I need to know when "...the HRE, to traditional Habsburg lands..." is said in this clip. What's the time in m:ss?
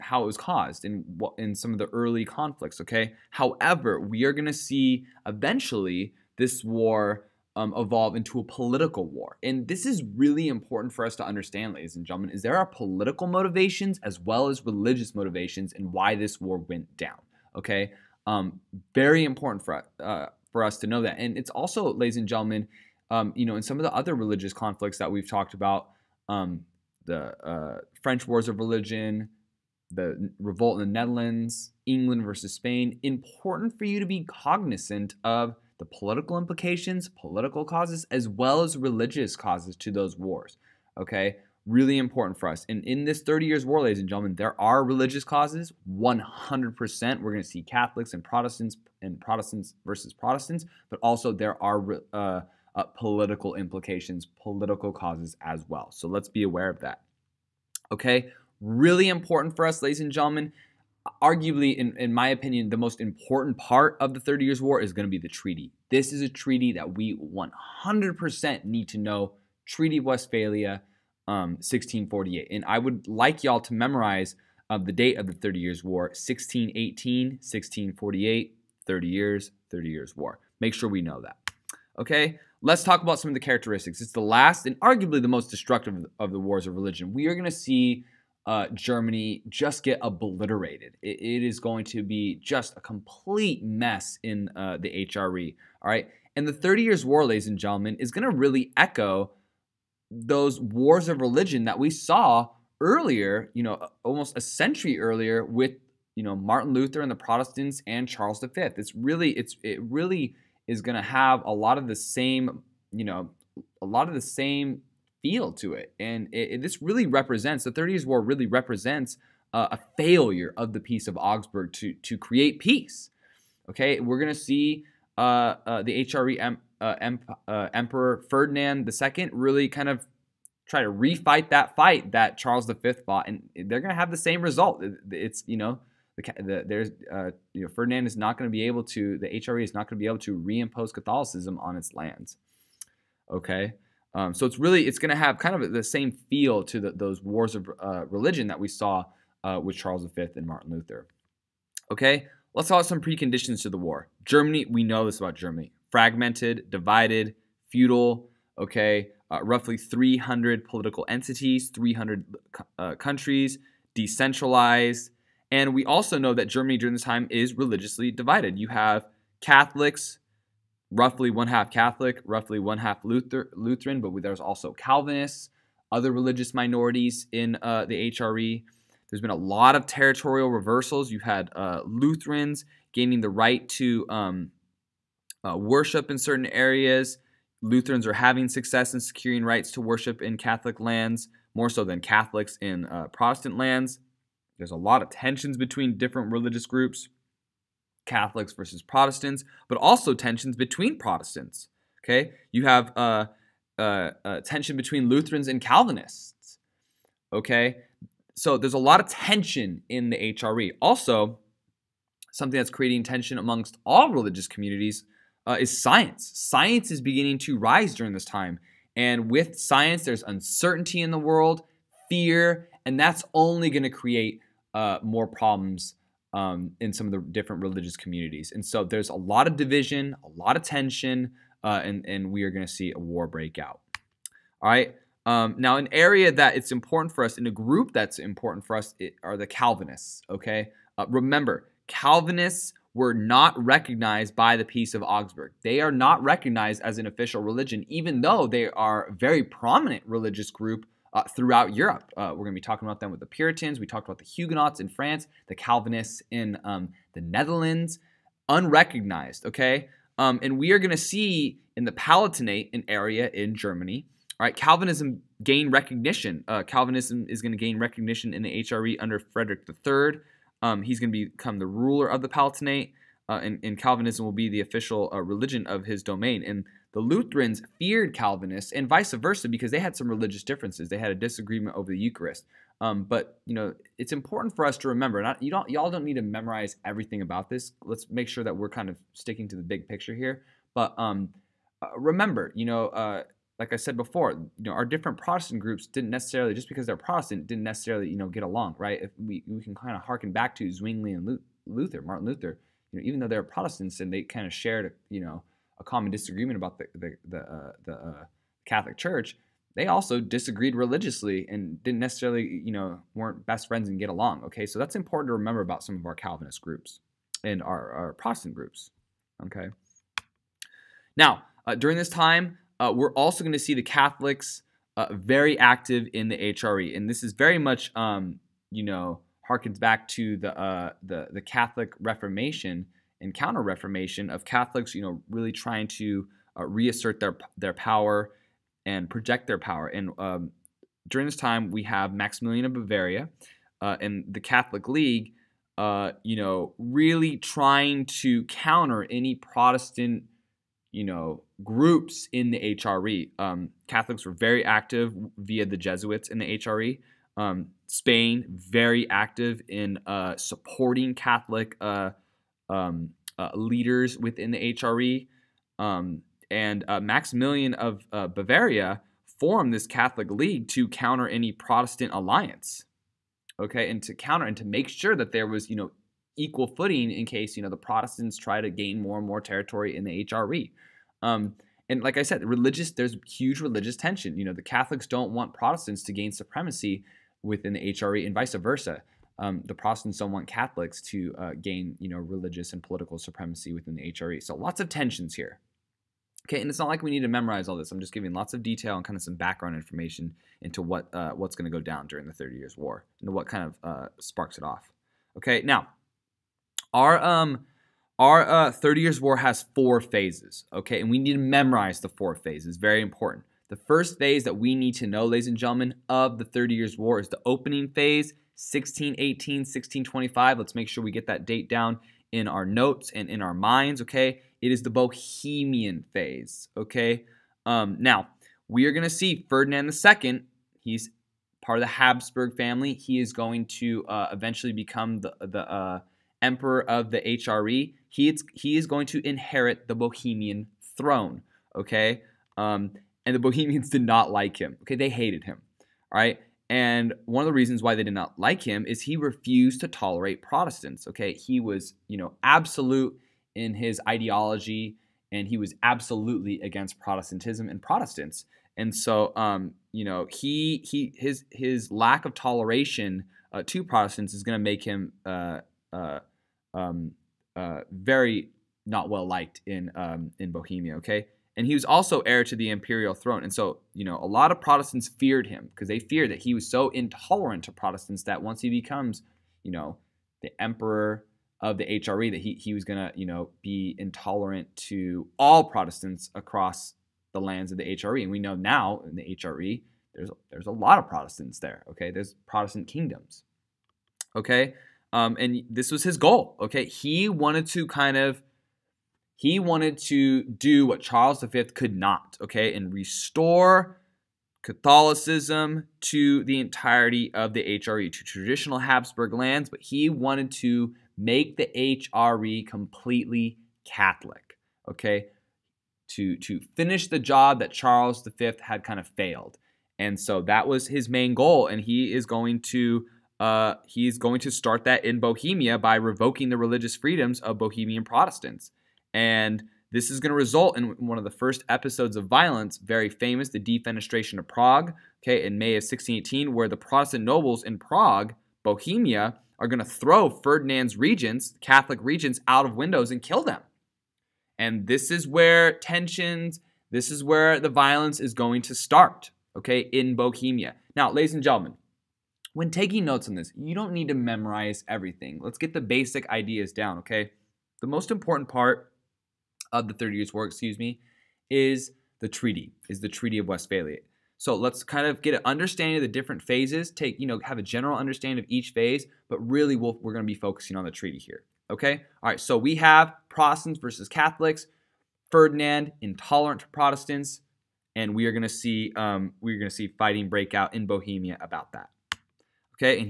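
8:27.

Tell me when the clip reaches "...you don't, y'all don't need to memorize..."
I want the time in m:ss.
4:45.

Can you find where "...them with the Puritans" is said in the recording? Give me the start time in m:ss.
4:12.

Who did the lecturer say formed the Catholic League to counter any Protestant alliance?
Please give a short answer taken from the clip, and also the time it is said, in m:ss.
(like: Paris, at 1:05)
Maximilian of Bavaria, at 5:42.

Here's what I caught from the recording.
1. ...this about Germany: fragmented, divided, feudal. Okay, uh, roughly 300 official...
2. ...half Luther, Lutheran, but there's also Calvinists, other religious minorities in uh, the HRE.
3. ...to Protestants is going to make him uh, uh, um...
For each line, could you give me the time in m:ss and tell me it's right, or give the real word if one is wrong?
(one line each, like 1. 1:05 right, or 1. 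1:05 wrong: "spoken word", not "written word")
1. 2:35 wrong: "political", not "official"
2. 2:52 right
3. 7:43 right.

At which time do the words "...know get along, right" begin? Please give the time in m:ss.
4:58.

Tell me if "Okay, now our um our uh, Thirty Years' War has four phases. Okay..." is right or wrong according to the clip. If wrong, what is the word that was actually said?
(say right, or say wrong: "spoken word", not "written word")
right.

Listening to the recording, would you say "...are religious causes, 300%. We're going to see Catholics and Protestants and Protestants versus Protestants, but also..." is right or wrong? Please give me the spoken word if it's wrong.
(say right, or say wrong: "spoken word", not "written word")
wrong: "100", not "300".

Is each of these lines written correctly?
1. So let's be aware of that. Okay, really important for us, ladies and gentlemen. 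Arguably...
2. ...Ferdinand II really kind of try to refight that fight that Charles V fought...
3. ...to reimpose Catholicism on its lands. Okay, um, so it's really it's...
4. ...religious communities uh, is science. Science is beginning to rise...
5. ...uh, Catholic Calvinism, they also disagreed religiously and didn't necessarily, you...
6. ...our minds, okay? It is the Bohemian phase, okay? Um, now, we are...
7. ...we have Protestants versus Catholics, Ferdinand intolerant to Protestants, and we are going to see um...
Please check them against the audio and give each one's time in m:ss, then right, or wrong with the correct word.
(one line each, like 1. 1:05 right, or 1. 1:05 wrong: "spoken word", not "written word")
1. 0:55 right
2. 2:08 right
3. 2:20 right
4. 3:34 right
5. 5:07 wrong: "Church", not "Calvinism"
6. 7:03 right
7. 9:32 right.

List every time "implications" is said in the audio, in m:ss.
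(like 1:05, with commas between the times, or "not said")
0:36, 0:53.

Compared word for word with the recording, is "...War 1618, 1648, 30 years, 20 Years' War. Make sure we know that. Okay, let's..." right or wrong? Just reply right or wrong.
wrong.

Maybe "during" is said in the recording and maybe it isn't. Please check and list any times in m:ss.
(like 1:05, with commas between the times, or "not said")
2:46, 3:37, 5:21, 5:41, 6:42.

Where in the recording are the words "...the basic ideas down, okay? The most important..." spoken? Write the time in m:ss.
9:15.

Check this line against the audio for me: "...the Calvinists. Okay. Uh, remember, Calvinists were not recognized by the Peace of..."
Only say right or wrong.
right.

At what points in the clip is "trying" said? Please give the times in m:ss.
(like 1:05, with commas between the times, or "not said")
5:35, 5:47.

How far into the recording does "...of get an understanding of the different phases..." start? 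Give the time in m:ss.
9:25.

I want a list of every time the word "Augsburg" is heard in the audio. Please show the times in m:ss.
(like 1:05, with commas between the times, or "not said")
2:01, 4:05.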